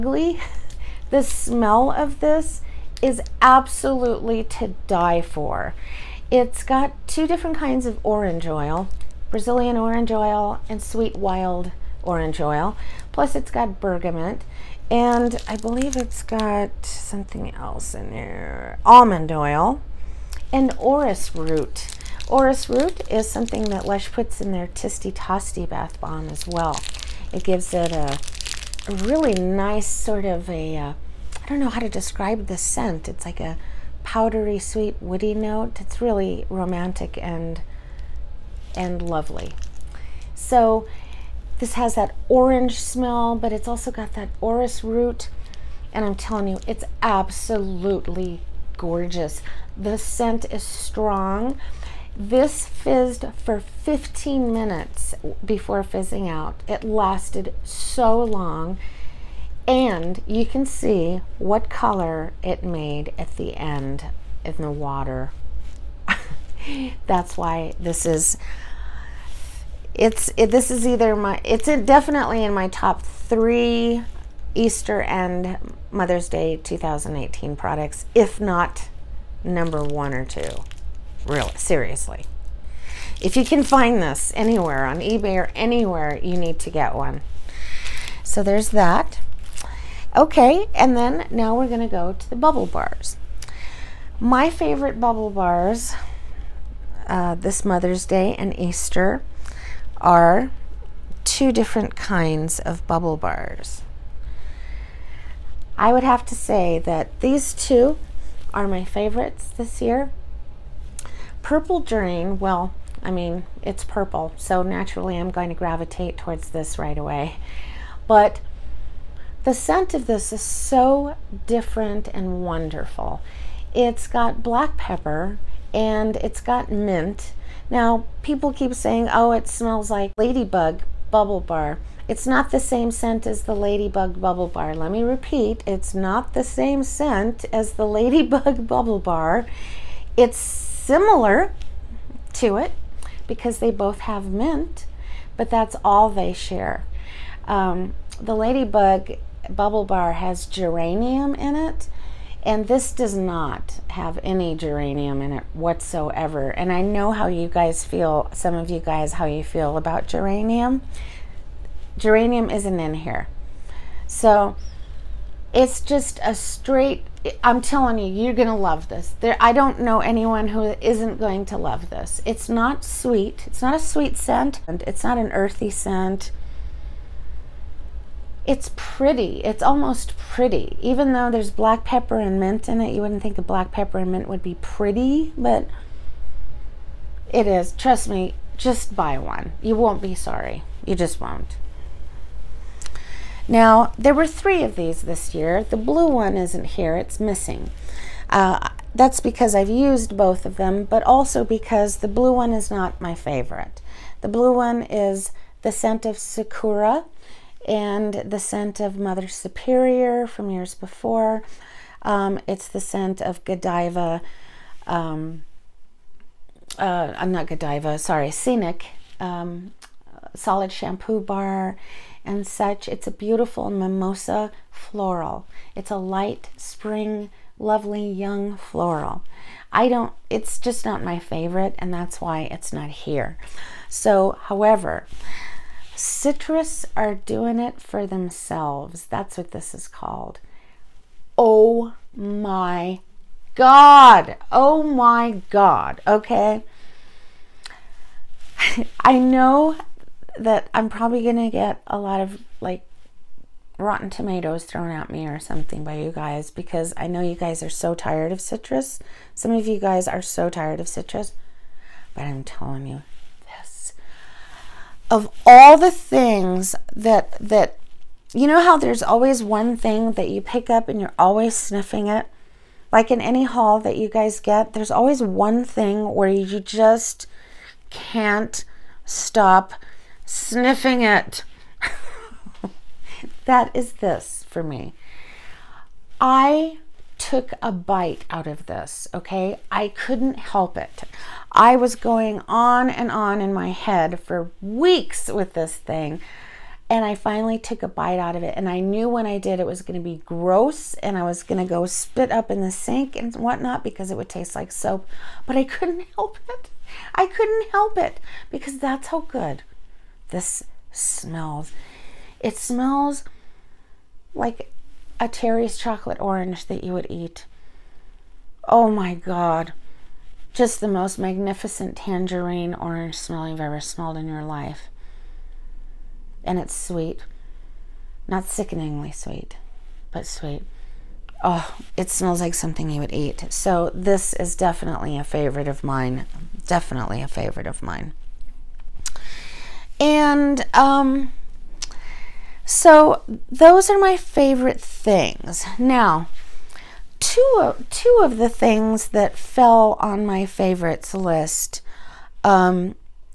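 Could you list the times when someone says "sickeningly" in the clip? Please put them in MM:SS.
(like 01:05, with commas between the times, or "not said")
05:28.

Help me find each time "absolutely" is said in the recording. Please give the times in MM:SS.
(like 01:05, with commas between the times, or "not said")
00:03, 00:47.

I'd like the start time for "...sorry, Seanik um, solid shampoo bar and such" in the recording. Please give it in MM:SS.
03:37.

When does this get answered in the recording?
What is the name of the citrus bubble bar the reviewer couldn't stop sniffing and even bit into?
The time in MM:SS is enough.
03:55.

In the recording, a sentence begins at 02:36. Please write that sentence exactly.
And I know how you guys feel, some of you guys, how you feel about geranium.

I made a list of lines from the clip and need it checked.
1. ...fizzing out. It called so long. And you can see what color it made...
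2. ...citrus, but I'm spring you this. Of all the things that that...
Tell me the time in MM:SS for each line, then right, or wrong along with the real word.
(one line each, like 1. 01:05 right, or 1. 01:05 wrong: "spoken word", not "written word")
1. 00:55 wrong: "lasted", not "called"
2. 04:20 wrong: "telling", not "spring".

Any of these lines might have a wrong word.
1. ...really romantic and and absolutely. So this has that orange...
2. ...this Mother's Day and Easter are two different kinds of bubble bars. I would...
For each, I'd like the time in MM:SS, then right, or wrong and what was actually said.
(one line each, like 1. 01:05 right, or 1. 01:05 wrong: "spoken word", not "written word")
1. 00:35 wrong: "lovely", not "absolutely"
2. 01:37 right.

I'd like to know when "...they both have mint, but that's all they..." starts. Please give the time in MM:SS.
02:23.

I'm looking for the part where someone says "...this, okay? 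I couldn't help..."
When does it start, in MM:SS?
04:48.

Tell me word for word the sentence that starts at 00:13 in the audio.
Plus it's got bergamot and I believe it's got something else in there, almond oil and orris root.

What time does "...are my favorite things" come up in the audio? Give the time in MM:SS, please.
05:43.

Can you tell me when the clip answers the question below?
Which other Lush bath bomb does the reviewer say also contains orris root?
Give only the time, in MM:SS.
00:24.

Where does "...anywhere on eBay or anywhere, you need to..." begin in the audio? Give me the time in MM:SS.
01:24.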